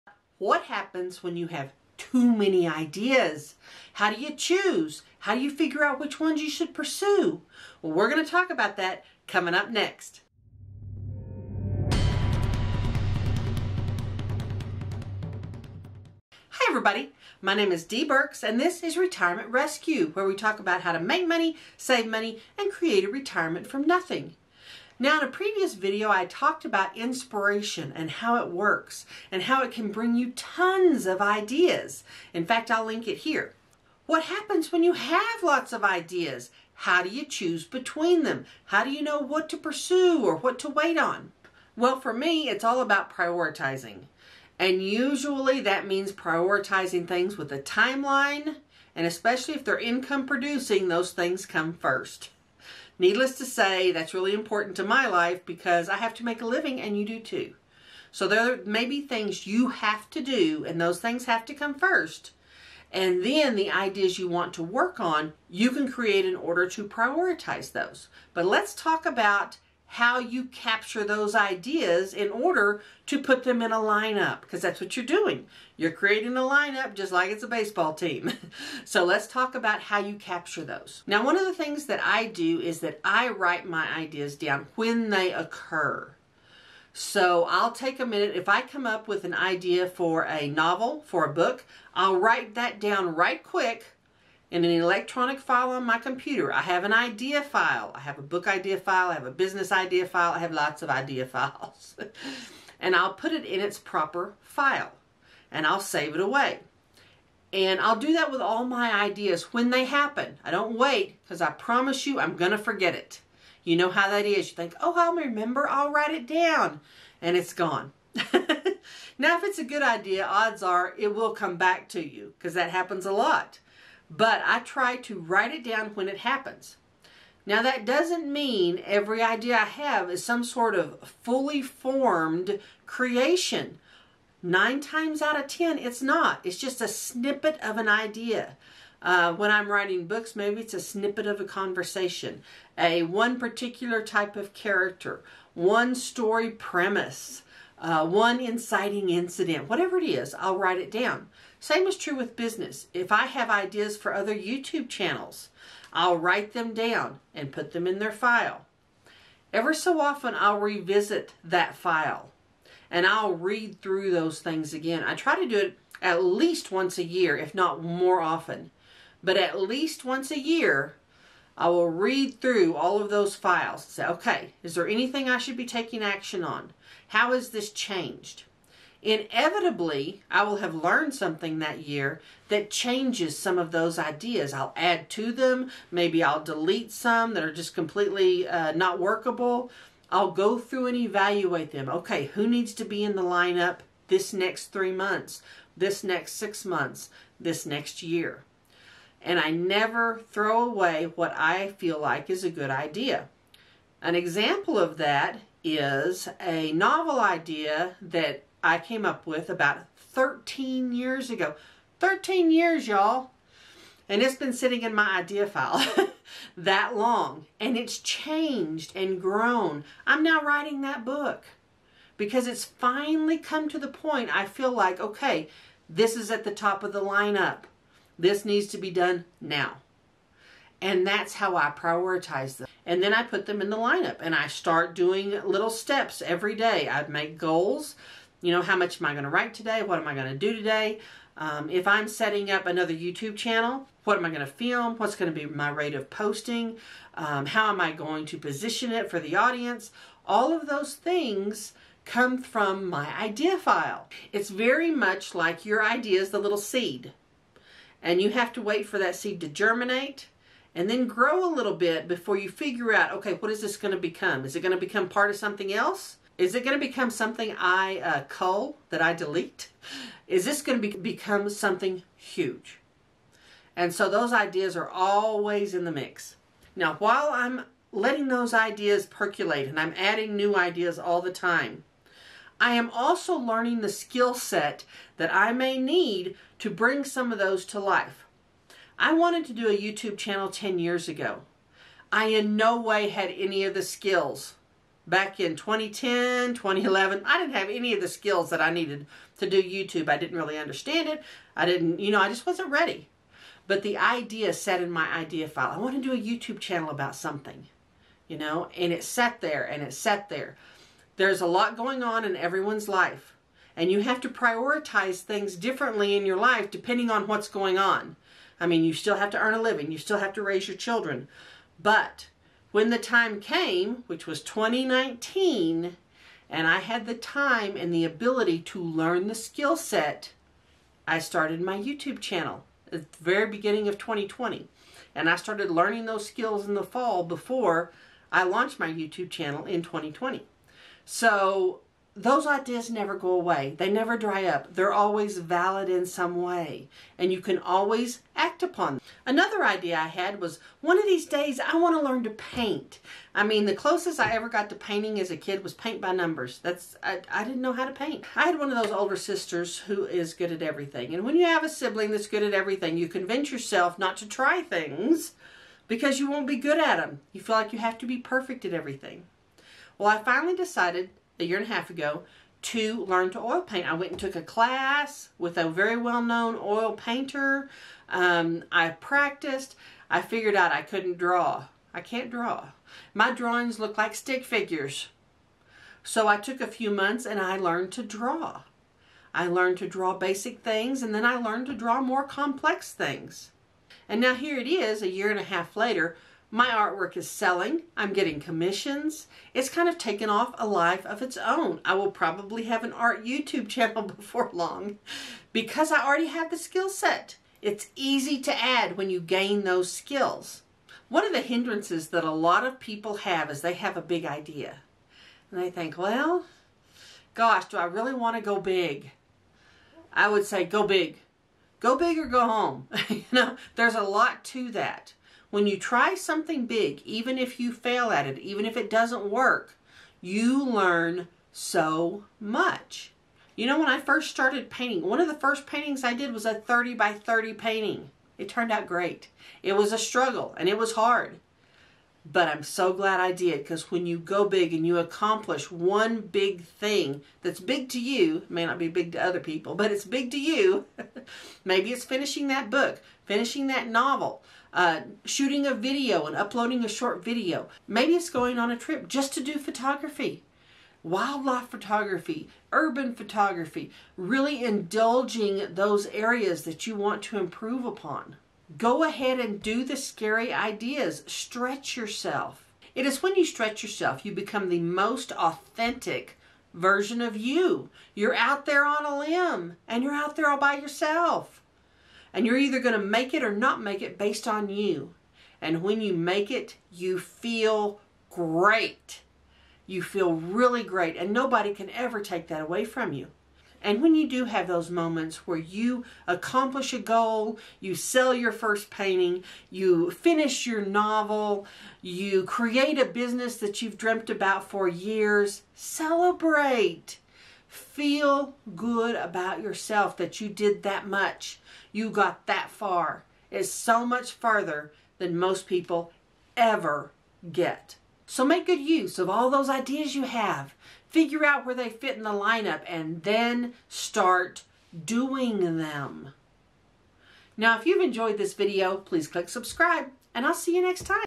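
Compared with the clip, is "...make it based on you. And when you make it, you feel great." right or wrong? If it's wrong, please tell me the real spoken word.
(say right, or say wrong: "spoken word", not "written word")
right.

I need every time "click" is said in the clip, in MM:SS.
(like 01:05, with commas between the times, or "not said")
08:49.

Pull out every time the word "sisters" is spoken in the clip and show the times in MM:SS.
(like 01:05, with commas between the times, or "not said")
05:59.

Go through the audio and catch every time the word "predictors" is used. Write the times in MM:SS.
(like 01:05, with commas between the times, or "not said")
not said.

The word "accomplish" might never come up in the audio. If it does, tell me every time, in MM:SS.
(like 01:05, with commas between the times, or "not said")
07:24, 08:16.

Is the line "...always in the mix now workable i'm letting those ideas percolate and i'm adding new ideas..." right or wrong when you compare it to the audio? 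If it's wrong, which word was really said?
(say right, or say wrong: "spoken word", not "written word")
wrong: "while", not "workable".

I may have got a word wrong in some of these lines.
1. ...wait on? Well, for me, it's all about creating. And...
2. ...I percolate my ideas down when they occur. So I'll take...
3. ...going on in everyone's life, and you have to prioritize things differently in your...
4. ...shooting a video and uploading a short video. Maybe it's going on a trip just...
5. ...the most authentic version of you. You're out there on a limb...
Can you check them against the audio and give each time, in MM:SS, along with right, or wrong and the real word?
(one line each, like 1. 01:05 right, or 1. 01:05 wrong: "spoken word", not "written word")
1. 00:40 wrong: "prioritizing", not "creating"
2. 01:23 wrong: "write", not "percolate"
3. 05:11 right
4. 07:35 right
5. 07:54 right.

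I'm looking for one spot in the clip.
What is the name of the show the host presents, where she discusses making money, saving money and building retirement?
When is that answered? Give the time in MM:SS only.
00:18.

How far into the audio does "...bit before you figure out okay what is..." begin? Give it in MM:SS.
04:21.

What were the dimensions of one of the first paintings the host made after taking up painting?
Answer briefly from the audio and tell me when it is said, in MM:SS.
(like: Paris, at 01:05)
30 by 30, at 07:16.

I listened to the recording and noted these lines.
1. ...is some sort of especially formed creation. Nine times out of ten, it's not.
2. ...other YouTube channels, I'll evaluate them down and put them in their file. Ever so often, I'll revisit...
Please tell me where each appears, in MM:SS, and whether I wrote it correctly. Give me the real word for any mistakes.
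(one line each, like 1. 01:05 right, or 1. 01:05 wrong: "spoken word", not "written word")
1. 02:10 wrong: "fully", not "especially"
2. 02:34 wrong: "write", not "evaluate".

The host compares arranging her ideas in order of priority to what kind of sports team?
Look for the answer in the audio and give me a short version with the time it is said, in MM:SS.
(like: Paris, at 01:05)
baseball team, at 01:17.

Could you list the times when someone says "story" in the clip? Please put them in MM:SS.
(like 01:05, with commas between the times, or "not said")
02:25.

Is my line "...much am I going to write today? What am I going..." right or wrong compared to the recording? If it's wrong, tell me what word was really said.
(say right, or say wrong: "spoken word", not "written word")
right.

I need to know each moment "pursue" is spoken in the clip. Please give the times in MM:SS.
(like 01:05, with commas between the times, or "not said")
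00:06, 00:39.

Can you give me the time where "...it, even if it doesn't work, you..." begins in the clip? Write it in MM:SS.
07:08.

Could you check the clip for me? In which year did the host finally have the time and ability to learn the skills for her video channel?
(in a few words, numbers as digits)
2019.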